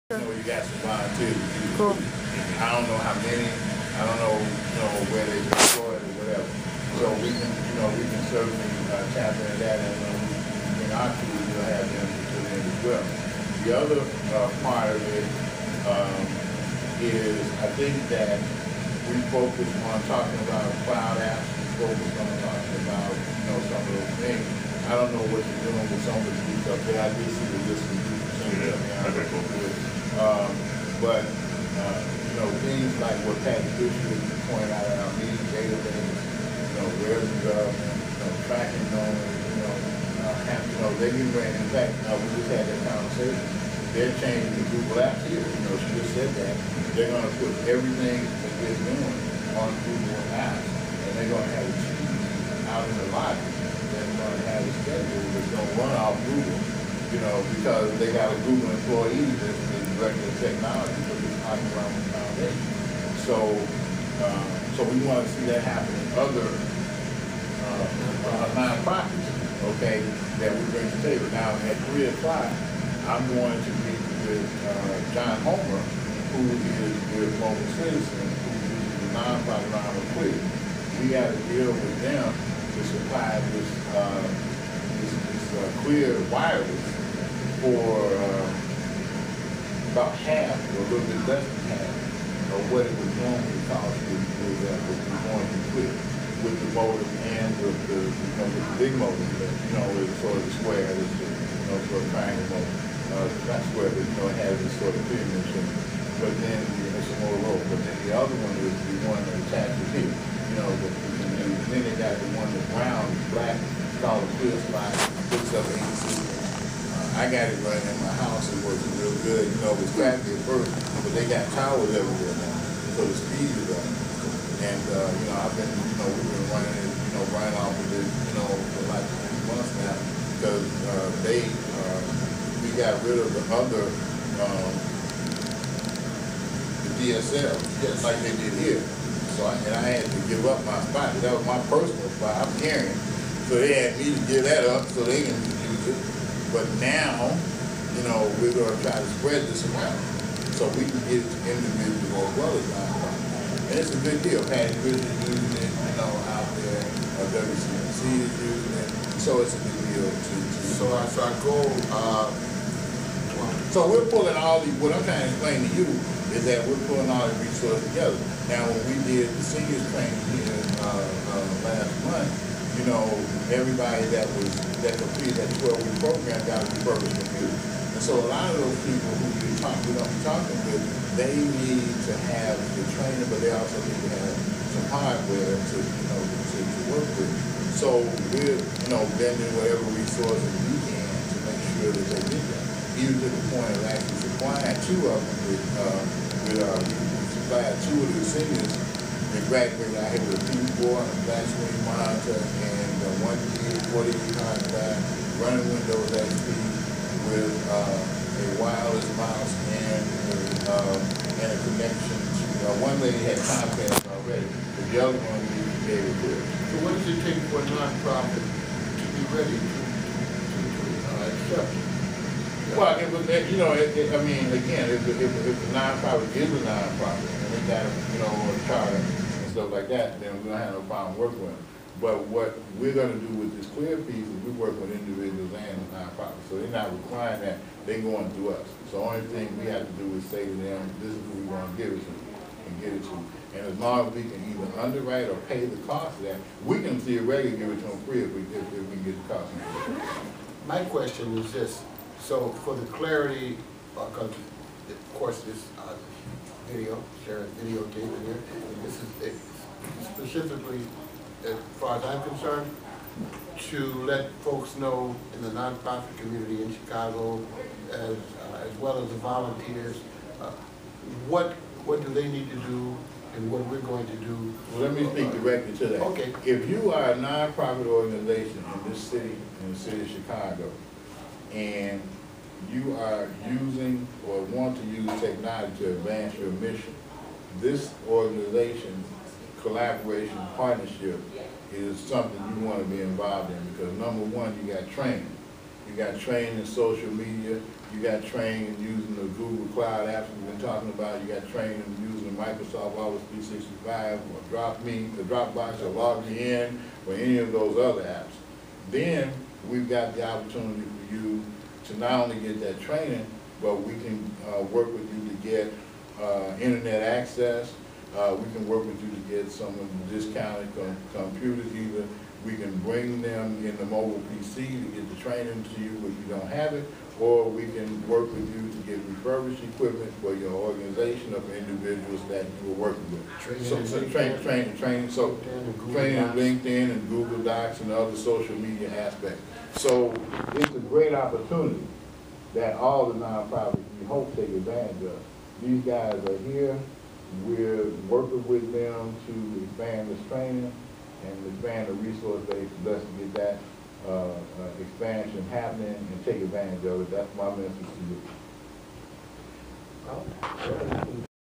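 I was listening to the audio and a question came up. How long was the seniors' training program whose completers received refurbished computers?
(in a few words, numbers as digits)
12 weeks.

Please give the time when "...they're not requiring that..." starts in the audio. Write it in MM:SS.
03:56.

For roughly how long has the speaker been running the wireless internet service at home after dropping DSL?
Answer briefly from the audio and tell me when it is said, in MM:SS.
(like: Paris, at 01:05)
3 months, at 02:09.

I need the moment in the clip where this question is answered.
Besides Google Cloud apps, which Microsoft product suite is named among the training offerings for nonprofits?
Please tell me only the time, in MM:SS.
05:02.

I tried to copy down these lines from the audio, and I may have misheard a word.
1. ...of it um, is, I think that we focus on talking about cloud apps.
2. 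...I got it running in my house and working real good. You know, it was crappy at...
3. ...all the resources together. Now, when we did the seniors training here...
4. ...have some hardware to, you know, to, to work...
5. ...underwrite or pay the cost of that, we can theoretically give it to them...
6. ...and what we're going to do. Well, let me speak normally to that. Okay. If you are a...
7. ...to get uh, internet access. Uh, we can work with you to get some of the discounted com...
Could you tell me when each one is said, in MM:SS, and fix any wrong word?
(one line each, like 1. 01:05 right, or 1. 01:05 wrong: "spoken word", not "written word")
1. 00:14 right
2. 01:57 right
3. 02:47 right
4. 03:04 right
5. 04:04 right
6. 04:33 wrong: "directly", not "normally"
7. 05:15 right.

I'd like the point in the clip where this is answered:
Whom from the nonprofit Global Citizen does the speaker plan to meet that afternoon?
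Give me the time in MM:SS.
01:15.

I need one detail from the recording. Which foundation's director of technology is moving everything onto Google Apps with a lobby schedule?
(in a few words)
Oxfam Foundation.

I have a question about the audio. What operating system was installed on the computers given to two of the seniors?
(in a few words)
Windows XP.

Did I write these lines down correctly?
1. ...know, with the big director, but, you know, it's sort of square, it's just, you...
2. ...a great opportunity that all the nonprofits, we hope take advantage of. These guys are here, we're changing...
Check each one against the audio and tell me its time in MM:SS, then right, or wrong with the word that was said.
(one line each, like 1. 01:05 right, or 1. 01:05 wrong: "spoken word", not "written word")
1. 01:38 wrong: "motor", not "director"
2. 05:40 wrong: "working", not "changing".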